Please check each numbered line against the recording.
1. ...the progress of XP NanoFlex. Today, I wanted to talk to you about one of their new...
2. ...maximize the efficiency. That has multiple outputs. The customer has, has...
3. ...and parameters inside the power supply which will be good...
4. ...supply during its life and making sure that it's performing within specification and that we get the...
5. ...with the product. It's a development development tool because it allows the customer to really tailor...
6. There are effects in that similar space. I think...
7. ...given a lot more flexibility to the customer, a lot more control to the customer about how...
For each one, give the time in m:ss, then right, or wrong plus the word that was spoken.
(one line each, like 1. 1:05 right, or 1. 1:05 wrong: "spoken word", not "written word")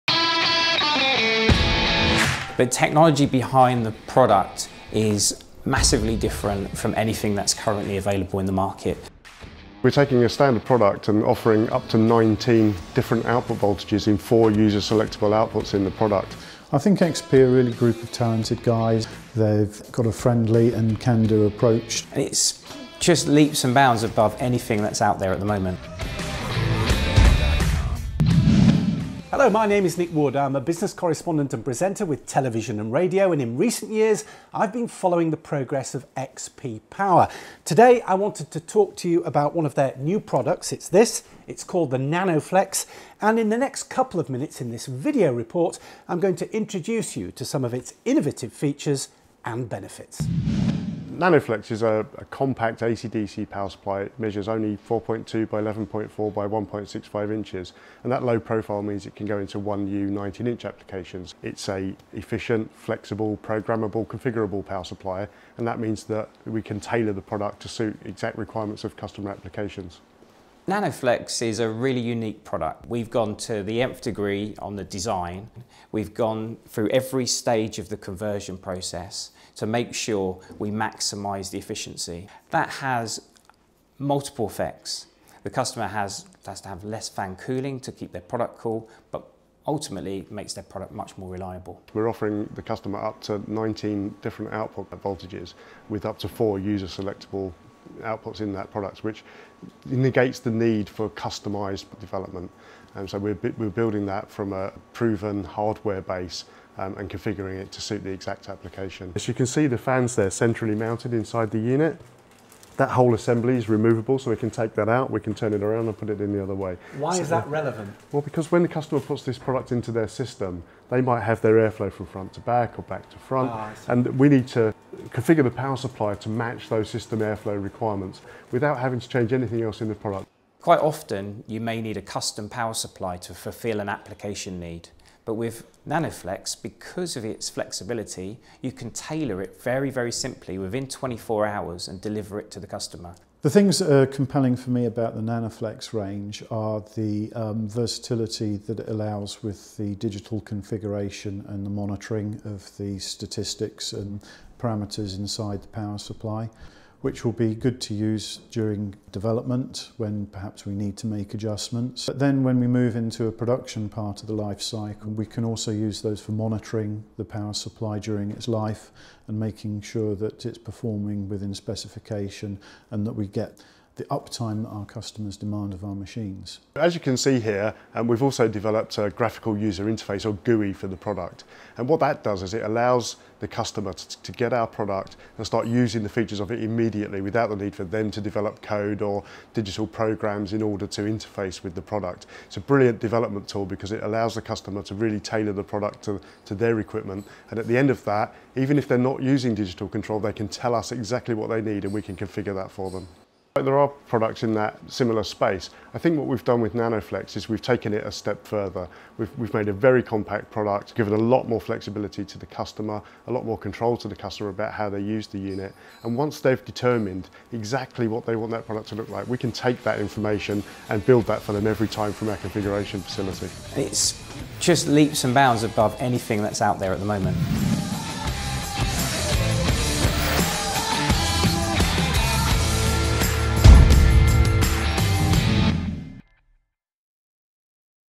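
1. 0:35 wrong: "Power", not "NanoFlex"
2. 1:20 wrong: "effects", not "outputs"
3. 2:33 right
4. 2:47 right
5. 3:11 wrong: "brilliant", not "development"
6. 3:23 wrong: "products", not "effects"
7. 3:30 right.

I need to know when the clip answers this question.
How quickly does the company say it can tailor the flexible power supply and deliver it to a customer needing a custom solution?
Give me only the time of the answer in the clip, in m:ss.
2:20.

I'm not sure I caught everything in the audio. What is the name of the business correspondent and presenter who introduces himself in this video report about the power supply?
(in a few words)
Nick Wood.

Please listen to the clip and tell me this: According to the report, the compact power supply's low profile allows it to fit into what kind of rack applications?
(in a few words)
1U 19-inch.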